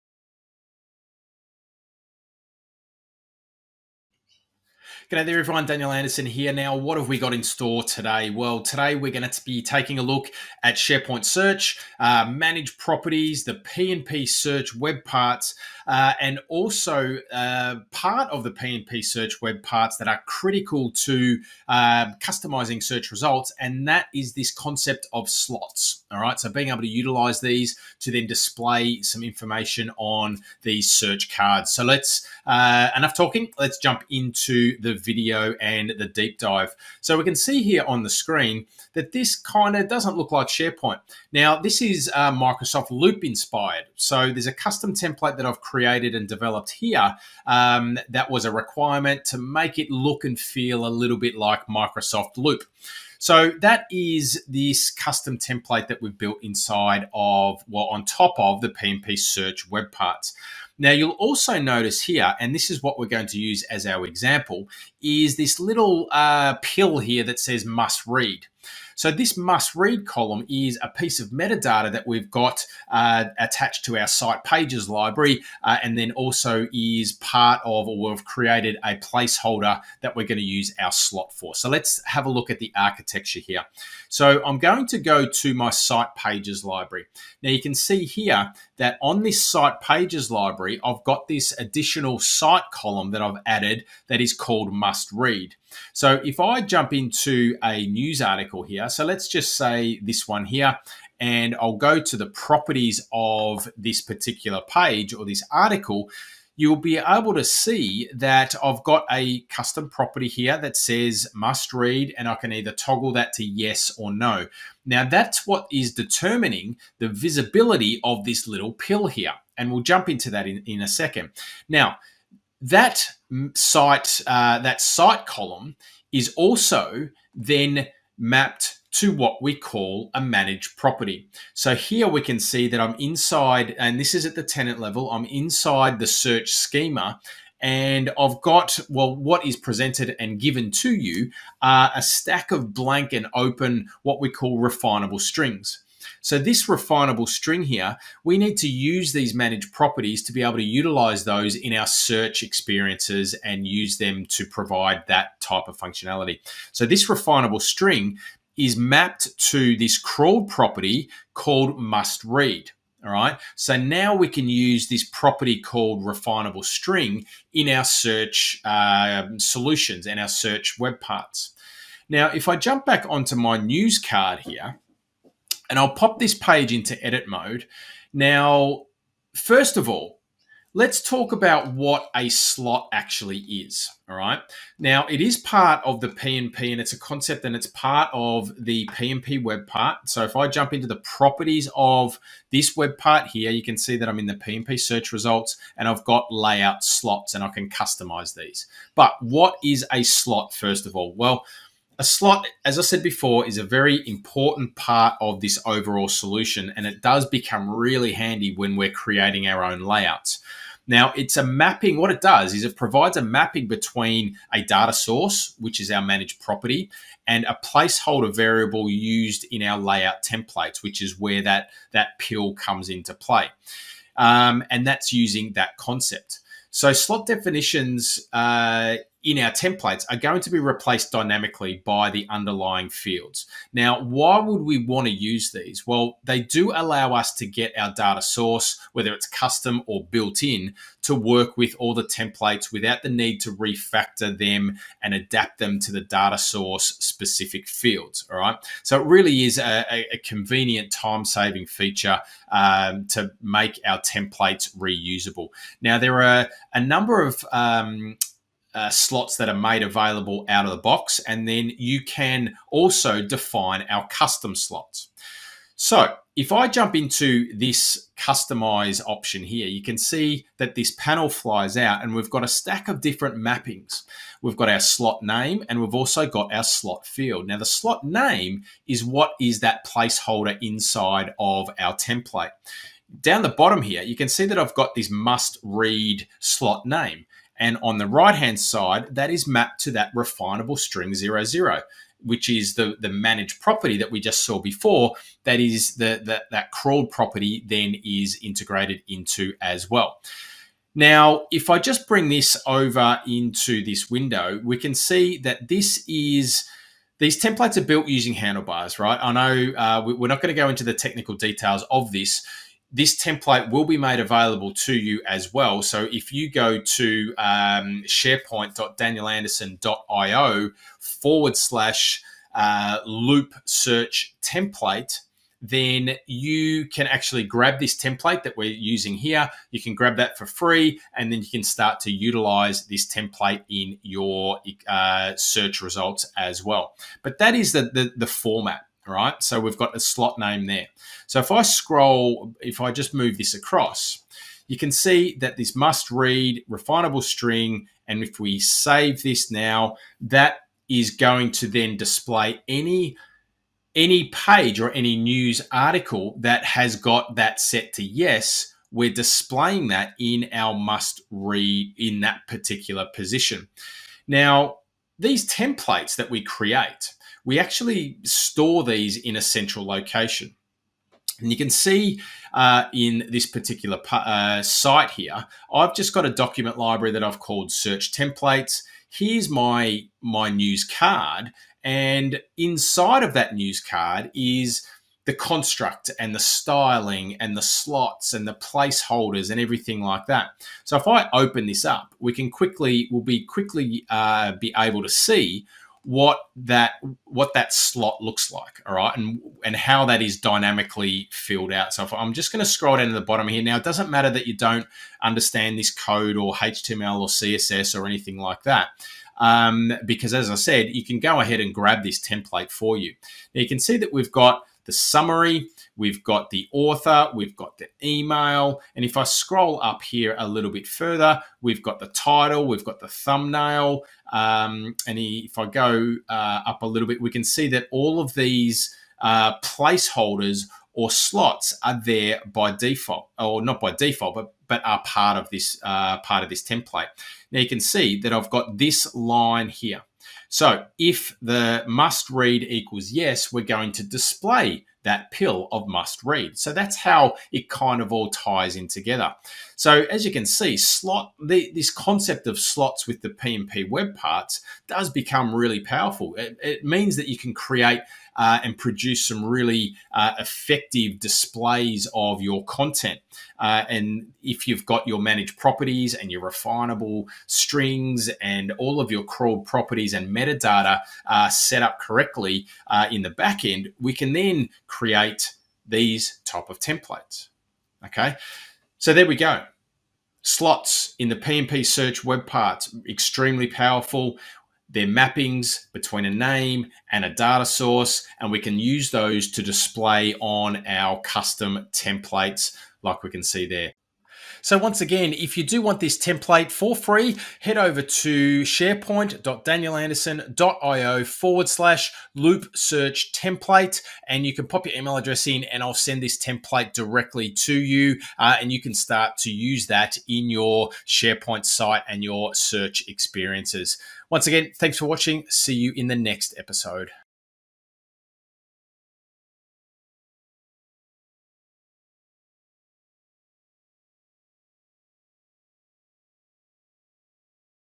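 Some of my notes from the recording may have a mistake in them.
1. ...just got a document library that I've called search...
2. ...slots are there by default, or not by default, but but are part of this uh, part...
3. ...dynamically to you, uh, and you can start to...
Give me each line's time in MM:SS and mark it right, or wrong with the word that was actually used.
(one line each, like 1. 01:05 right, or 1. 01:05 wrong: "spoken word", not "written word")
1. 06:15 right
2. 07:11 right
3. 08:26 wrong: "directly", not "dynamically".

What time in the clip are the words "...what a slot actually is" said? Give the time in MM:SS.
03:01.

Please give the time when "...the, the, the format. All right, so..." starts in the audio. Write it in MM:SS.
05:37.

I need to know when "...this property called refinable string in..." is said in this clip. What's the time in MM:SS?
02:44.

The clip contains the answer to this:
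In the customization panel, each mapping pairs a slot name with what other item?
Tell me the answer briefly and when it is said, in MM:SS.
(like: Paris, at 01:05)
slot field, at 04:36.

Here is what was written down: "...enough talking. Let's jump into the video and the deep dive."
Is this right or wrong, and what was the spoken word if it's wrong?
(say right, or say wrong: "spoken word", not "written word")
right.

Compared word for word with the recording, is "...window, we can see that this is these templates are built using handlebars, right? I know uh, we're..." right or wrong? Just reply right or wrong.
right.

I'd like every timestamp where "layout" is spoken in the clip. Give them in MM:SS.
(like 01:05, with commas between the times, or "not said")
03:16, 03:29, 03:39.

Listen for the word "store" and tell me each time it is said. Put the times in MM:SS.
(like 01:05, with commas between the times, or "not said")
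00:07, 06:08.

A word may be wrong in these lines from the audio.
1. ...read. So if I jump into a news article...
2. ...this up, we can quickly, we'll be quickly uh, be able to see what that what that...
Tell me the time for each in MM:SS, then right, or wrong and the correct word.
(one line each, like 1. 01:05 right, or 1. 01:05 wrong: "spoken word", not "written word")
1. 01:35 right
2. 06:31 right.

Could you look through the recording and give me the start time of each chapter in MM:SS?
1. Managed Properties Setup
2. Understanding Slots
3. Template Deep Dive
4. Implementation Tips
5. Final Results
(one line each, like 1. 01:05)
1. 01:45
2. 02:52
3. 04:15
4. 06:30
5. 07:45.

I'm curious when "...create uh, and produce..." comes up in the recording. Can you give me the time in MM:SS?
07:37.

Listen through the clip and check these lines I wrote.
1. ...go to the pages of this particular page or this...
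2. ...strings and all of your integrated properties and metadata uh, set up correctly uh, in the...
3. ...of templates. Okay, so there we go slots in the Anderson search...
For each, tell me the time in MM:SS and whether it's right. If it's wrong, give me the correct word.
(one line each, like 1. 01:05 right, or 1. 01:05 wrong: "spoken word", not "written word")
1. 01:41 wrong: "properties", not "pages"
2. 07:47 wrong: "crawled", not "integrated"
3. 07:56 wrong: "PnP", not "Anderson".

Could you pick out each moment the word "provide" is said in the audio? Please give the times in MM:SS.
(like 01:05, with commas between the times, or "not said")
02:34, 03:32.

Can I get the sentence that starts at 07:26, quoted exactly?
So that's how it kind of all ties in together.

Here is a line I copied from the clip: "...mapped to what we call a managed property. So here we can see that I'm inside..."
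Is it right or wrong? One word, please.
right.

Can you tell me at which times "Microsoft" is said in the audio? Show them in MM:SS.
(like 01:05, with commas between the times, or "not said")
00:42, 00:51.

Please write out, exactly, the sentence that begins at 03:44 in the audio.
Um, and that's using that concept.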